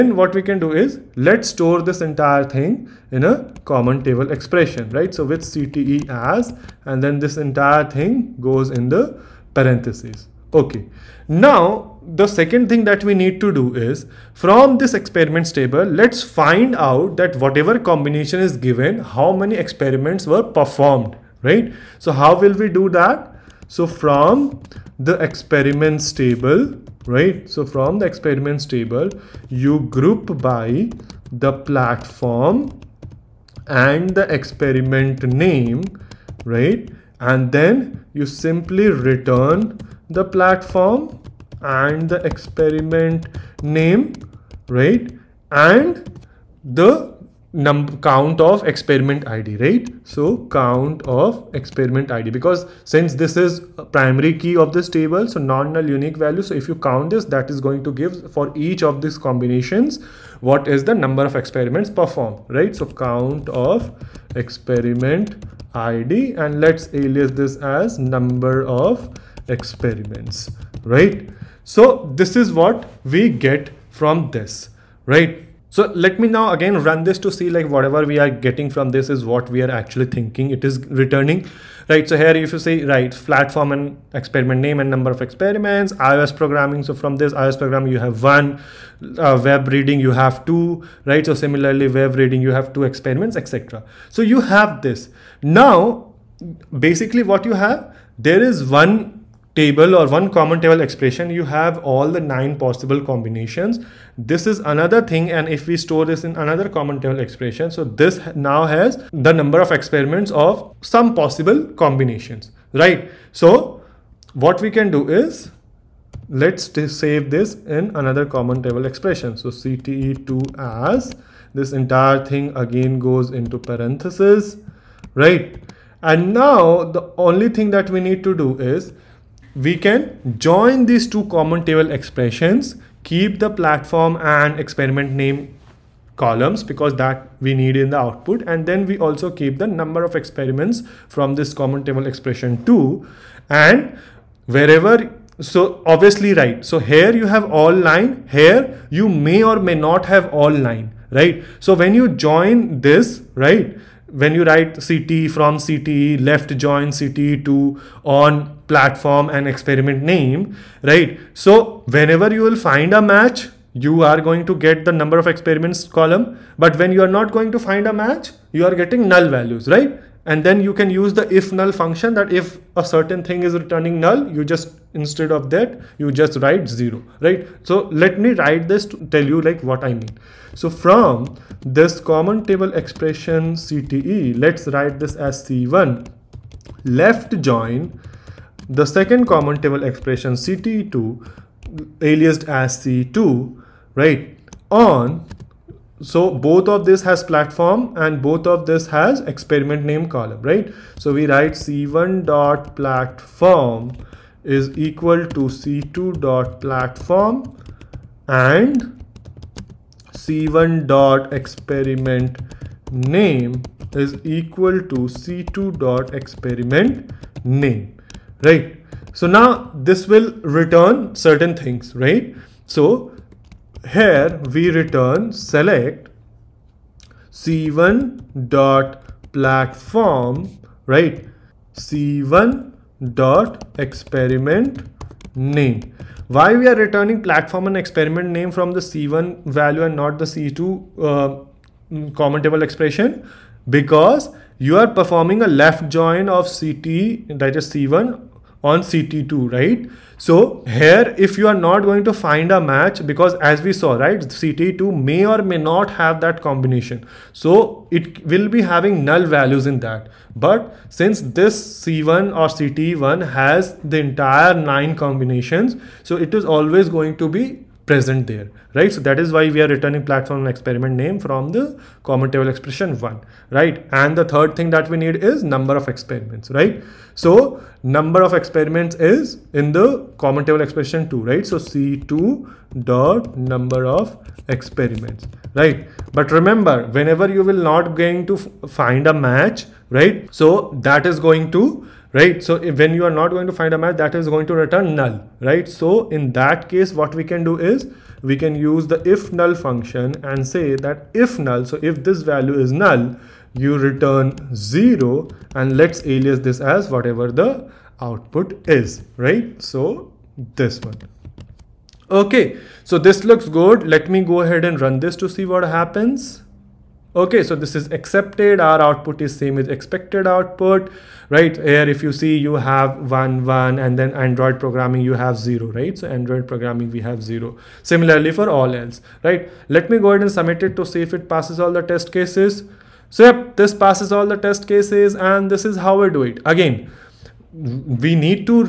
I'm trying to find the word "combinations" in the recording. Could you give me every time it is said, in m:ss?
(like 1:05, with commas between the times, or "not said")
0:17, 0:59, 1:43, 1:51, 4:16, 4:25.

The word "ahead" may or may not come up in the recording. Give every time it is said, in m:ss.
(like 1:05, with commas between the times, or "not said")
5:14, 5:30.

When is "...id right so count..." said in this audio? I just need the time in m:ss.
0:49.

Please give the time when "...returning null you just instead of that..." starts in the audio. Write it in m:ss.
2:53.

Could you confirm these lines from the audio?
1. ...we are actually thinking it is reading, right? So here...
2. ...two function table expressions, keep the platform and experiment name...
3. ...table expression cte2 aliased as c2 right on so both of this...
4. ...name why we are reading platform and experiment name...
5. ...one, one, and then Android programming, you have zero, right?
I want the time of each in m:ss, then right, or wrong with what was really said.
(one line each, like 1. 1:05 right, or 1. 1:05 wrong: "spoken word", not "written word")
1. 1:19 wrong: "returning", not "reading"
2. 2:11 wrong: "common", not "function"
3. 3:09 right
4. 3:55 wrong: "returning", not "reading"
5. 5:23 right.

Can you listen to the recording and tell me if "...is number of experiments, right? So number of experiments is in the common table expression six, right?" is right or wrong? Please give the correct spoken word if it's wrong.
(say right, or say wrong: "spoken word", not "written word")
wrong: "two", not "six".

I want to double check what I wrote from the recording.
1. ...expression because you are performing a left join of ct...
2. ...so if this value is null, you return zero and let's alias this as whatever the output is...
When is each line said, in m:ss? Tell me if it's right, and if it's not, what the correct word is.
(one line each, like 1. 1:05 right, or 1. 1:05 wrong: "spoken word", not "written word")
1. 4:02 right
2. 5:01 right.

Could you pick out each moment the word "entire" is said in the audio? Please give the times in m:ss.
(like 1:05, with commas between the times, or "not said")
0:02, 0:07, 2:01, 4:23.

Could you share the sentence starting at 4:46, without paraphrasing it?
But remember, whenever you will not going to find a match, right?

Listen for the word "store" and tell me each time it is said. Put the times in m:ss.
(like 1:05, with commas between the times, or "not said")
0:01, 1:45.